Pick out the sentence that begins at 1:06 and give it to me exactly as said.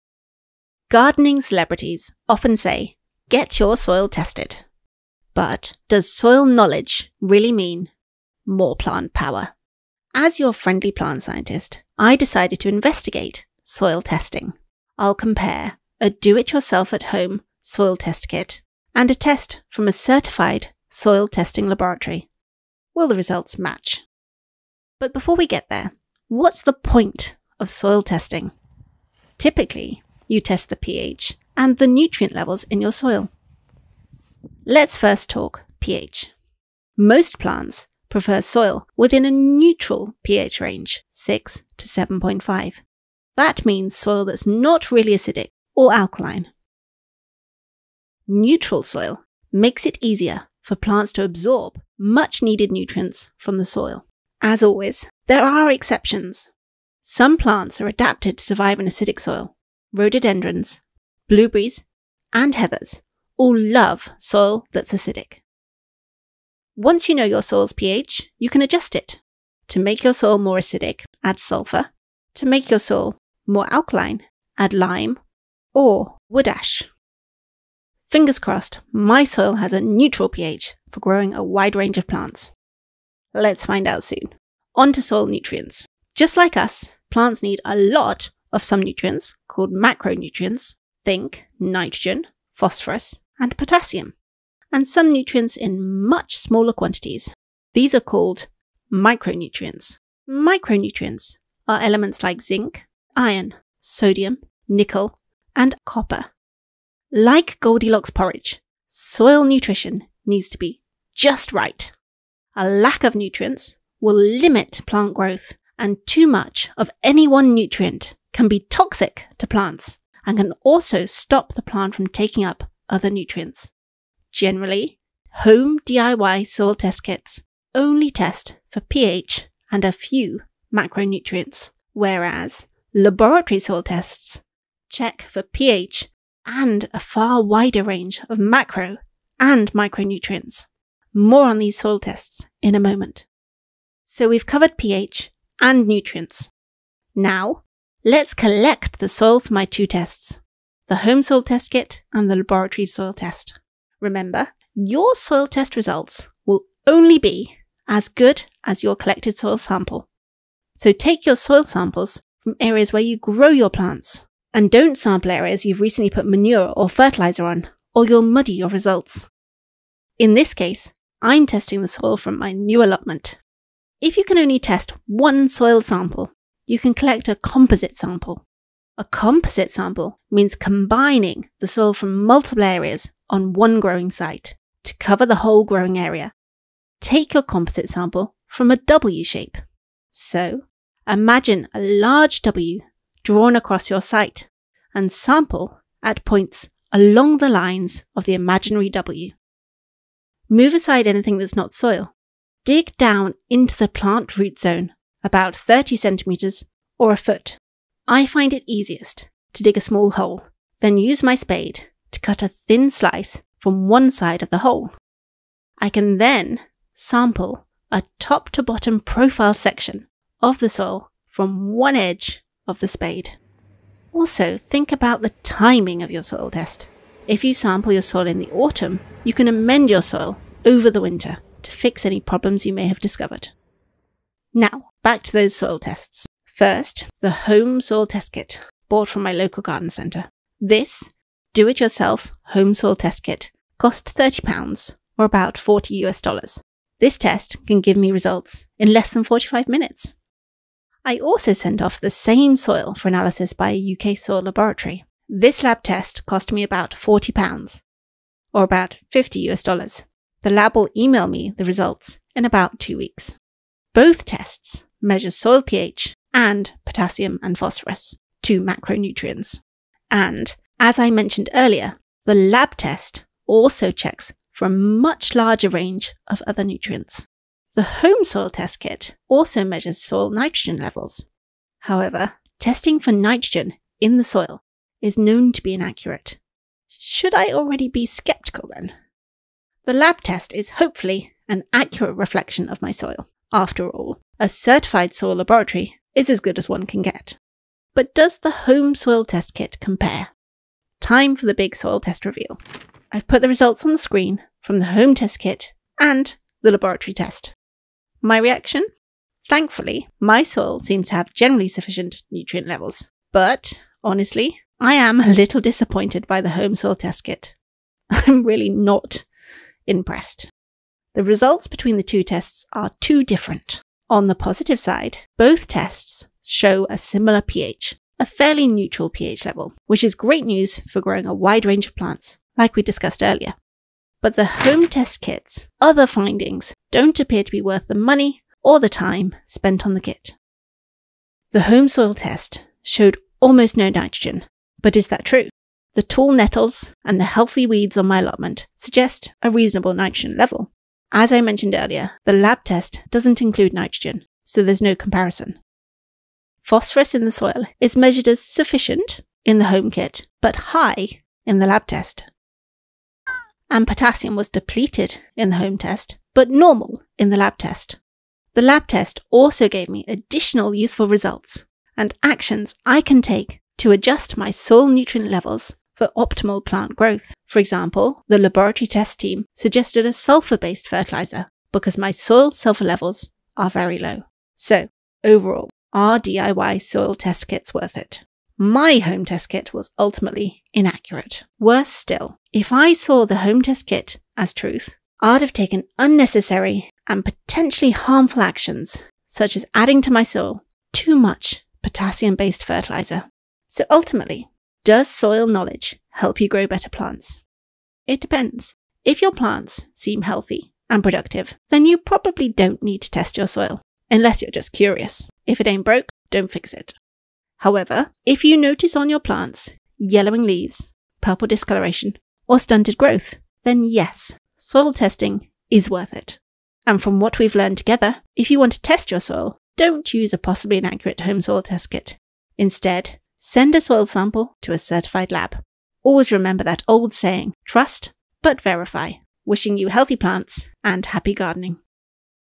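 Once you know your soil's pH, you can adjust it.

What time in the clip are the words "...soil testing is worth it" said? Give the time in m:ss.
7:04.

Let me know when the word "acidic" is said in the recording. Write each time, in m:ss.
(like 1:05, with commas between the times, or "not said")
0:45, 0:58, 1:04, 1:10.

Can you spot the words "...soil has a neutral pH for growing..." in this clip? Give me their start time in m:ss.
1:19.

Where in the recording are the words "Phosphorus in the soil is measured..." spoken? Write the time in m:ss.
5:56.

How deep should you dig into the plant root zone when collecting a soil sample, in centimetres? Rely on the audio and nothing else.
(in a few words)
30 centimetres.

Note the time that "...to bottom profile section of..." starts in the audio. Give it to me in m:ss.
3:38.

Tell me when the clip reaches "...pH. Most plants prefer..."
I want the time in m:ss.
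0:35.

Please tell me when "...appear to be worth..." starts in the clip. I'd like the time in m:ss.
5:37.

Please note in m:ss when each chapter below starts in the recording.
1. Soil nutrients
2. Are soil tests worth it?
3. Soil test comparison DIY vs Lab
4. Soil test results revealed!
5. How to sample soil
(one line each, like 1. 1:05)
1. 0:28
2. 6:24
3. 3:54
4. 5:00
5. 2:26.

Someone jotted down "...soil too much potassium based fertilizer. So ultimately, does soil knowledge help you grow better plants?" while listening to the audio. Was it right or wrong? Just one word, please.
right.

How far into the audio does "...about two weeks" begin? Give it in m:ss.
4:22.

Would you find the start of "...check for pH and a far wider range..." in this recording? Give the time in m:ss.
2:14.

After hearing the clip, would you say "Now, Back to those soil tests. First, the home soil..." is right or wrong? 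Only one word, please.
right.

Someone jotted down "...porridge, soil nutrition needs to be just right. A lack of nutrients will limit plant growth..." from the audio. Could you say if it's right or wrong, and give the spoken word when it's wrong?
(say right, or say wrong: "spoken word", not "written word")
right.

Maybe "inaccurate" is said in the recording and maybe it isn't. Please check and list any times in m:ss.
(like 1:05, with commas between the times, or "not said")
4:45, 6:30, 7:10.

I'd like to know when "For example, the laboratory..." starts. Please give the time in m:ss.
6:17.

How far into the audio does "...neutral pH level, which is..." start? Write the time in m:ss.
5:28.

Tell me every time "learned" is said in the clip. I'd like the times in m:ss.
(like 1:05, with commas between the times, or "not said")
7:07.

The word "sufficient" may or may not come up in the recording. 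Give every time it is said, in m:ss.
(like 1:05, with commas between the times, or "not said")
5:11, 5:58.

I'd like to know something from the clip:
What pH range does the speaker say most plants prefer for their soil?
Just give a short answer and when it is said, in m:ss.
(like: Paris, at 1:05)
6 to 7.5, at 0:41.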